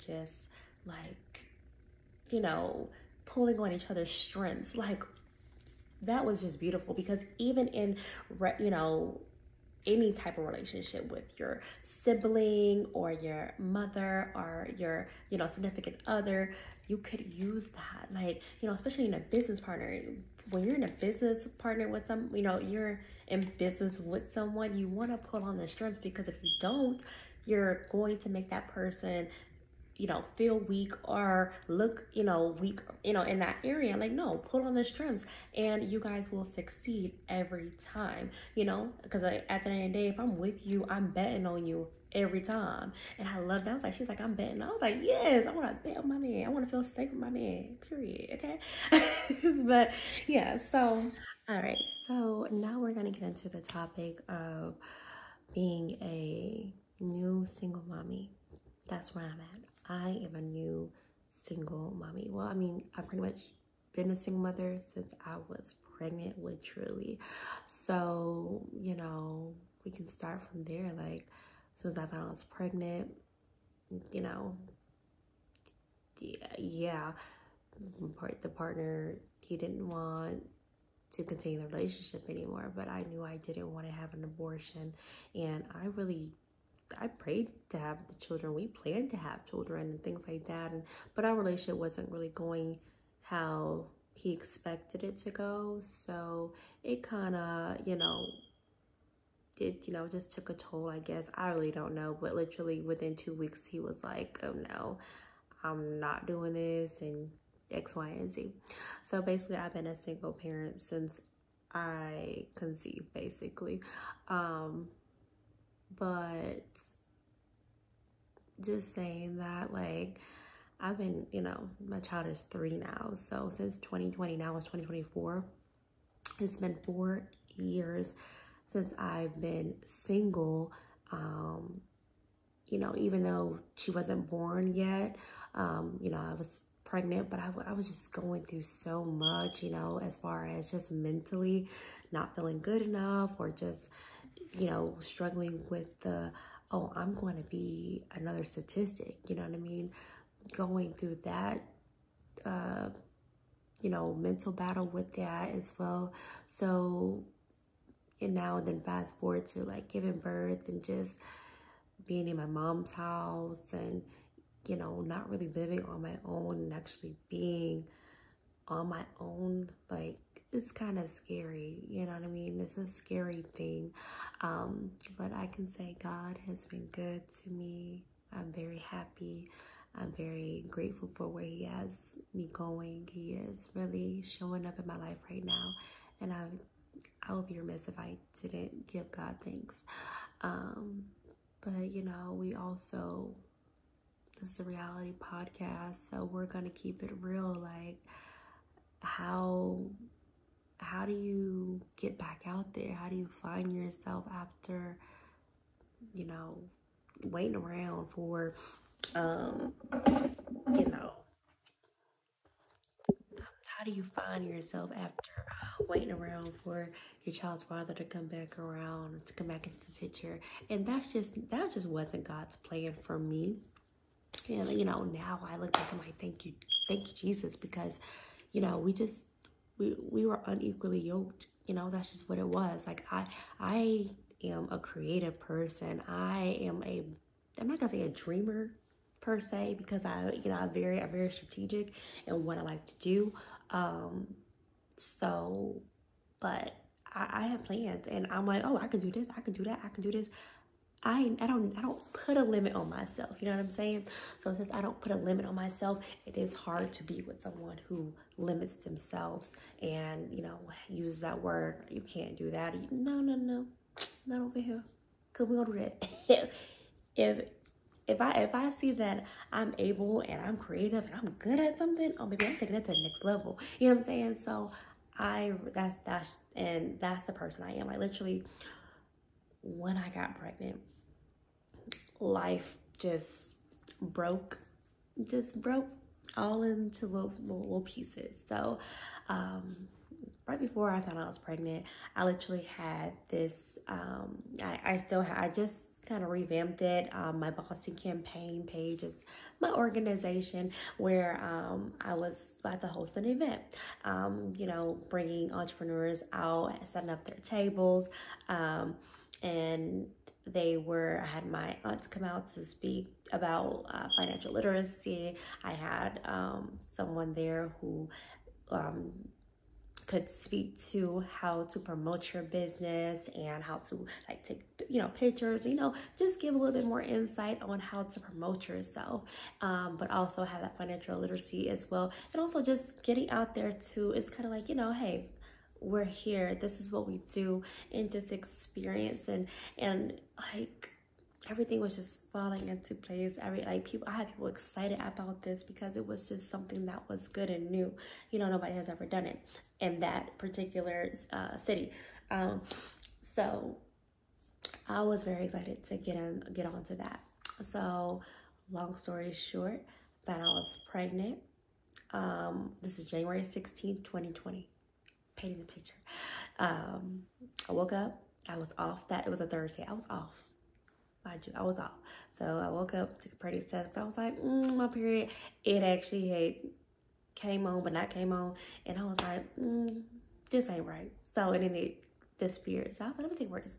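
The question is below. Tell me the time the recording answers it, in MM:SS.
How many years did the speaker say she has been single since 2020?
02:06.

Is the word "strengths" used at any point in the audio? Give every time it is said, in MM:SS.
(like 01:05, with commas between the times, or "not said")
00:04, 00:25.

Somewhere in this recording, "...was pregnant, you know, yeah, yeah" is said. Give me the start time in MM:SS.
01:12.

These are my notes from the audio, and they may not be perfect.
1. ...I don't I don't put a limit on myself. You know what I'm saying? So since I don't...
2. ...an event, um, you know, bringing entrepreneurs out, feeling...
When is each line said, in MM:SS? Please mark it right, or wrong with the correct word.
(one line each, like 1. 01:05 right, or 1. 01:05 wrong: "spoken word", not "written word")
1. 04:11 right
2. 05:03 wrong: "setting", not "feeling".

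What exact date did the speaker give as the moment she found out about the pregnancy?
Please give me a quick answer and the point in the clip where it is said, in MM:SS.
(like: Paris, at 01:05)
January 16, 2020, at 06:03.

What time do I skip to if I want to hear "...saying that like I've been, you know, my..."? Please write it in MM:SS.
01:58.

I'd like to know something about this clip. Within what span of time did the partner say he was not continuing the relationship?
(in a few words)
two weeks.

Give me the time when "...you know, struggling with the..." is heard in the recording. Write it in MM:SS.
02:24.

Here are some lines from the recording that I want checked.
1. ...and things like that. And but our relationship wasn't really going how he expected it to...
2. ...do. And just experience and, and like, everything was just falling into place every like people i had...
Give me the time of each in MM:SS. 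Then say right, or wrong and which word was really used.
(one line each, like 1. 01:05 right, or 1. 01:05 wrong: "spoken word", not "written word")
1. 01:29 right
2. 05:37 right.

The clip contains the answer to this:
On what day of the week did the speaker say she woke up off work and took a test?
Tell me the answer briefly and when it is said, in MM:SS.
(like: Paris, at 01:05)
Thursday, at 06:09.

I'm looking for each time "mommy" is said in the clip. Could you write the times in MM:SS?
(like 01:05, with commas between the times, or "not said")
00:57, 01:01.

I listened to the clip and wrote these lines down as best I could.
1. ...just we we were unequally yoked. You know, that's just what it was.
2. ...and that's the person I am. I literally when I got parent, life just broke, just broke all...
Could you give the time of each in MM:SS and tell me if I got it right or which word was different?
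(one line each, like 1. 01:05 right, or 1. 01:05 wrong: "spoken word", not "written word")
1. 03:48 right
2. 04:36 wrong: "pregnant", not "parent".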